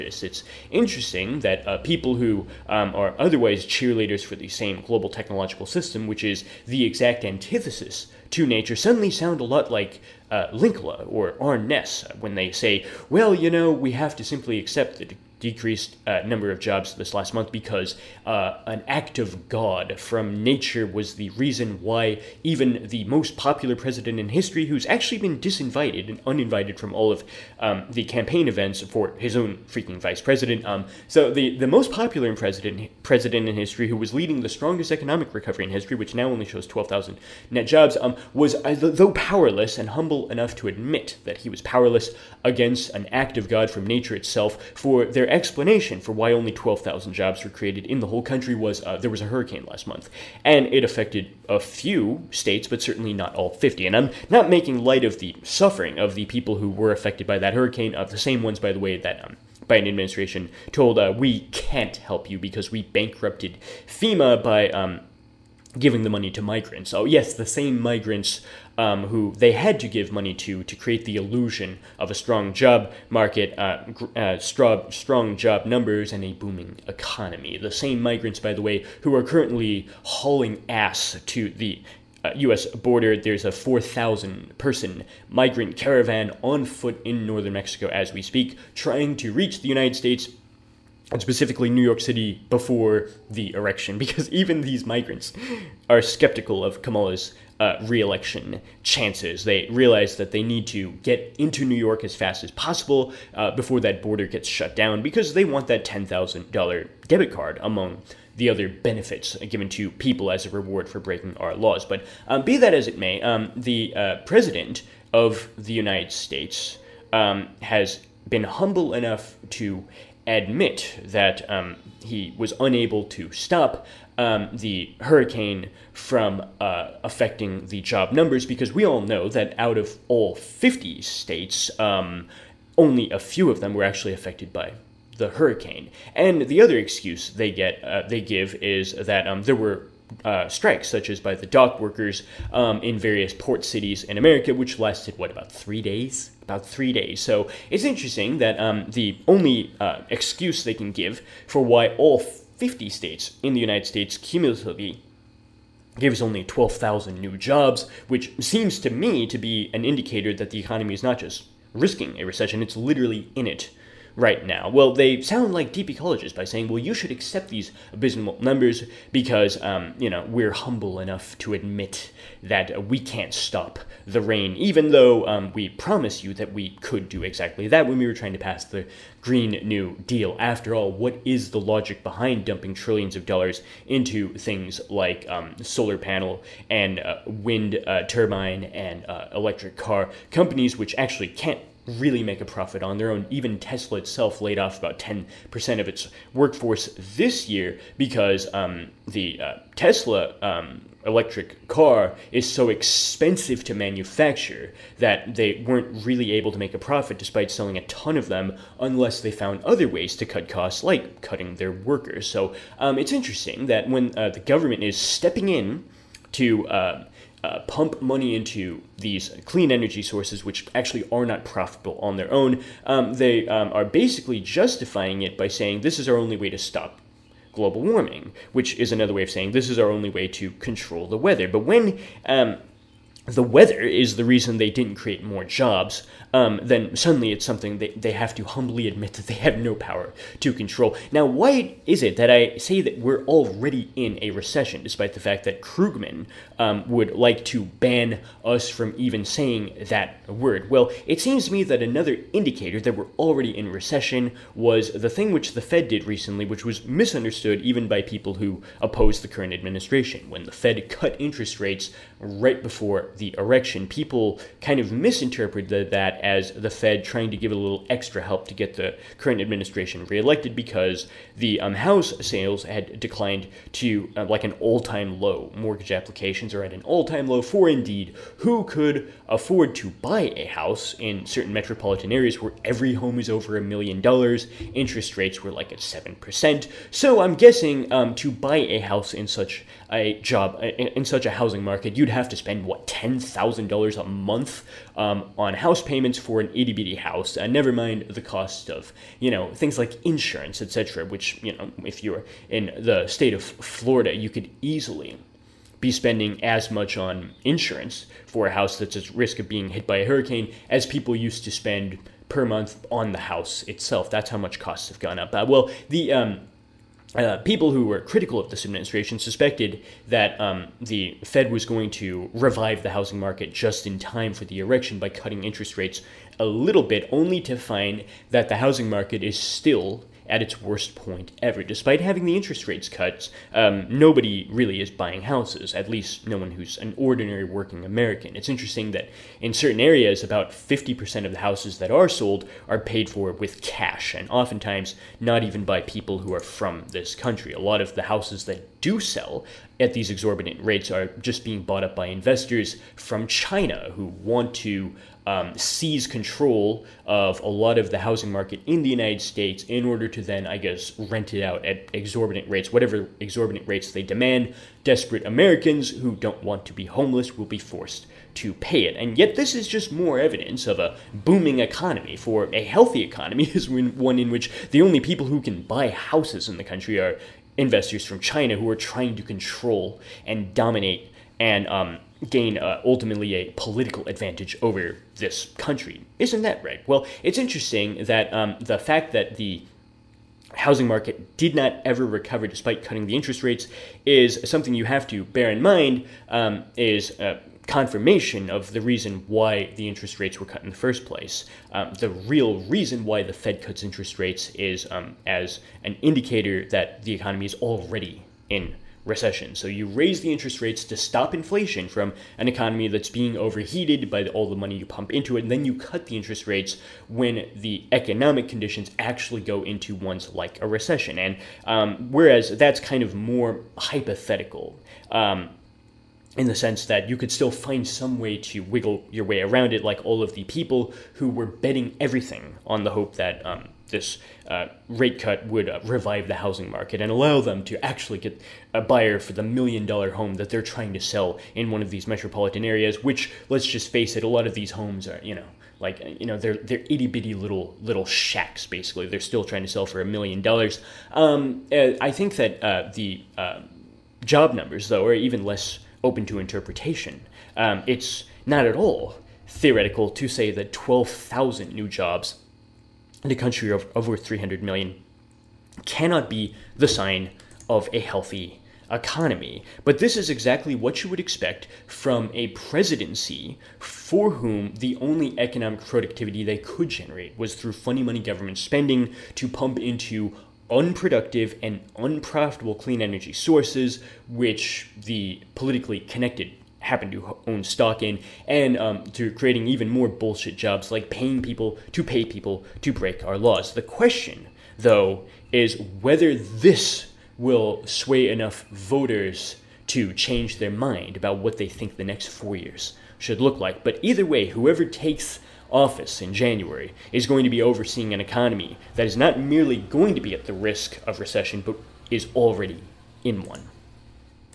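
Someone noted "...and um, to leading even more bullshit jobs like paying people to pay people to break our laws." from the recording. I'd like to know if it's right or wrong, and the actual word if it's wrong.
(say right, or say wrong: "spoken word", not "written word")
wrong: "creating", not "leading".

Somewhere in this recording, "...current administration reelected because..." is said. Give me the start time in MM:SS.
04:29.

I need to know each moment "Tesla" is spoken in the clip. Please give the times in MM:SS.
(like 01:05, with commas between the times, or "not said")
03:13, 03:19.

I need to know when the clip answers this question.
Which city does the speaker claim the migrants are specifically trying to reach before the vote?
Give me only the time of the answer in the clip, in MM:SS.
01:31.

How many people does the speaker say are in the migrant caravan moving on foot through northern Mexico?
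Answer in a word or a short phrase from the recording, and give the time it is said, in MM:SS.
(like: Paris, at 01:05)
4,000, at 01:23.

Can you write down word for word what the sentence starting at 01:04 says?
Um, giving the money to migrants.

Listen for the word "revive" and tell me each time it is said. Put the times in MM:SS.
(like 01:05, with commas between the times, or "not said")
05:22, 07:15.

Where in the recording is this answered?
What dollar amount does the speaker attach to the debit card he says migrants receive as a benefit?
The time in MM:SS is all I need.
01:45.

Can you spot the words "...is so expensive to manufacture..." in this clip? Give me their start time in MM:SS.
03:22.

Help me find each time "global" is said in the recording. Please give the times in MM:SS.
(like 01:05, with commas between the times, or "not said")
00:04, 03:47.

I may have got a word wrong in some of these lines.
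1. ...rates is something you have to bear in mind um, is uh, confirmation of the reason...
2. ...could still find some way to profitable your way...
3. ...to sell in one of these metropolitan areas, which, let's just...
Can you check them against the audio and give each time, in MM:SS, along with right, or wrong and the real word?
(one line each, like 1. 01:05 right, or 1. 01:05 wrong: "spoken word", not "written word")
1. 06:33 right
2. 07:07 wrong: "wiggle", not "profitable"
3. 07:20 right.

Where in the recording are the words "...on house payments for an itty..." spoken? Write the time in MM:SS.
04:55.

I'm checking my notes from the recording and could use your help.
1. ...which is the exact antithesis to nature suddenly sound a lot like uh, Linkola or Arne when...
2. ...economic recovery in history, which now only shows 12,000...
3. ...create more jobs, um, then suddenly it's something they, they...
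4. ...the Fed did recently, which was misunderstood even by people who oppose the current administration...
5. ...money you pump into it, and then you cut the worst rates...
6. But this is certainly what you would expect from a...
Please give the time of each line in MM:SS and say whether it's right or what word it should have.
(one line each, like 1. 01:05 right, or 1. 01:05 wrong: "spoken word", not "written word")
1. 00:06 right
2. 00:34 right
3. 03:54 right
4. 04:15 right
5. 06:54 wrong: "interest", not "worst"
6. 07:49 wrong: "exactly", not "certainly".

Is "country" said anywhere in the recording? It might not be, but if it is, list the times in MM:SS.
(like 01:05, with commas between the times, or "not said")
00:48, 05:47, 06:16, 06:25, 07:43.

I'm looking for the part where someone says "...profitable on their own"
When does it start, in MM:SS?
03:41.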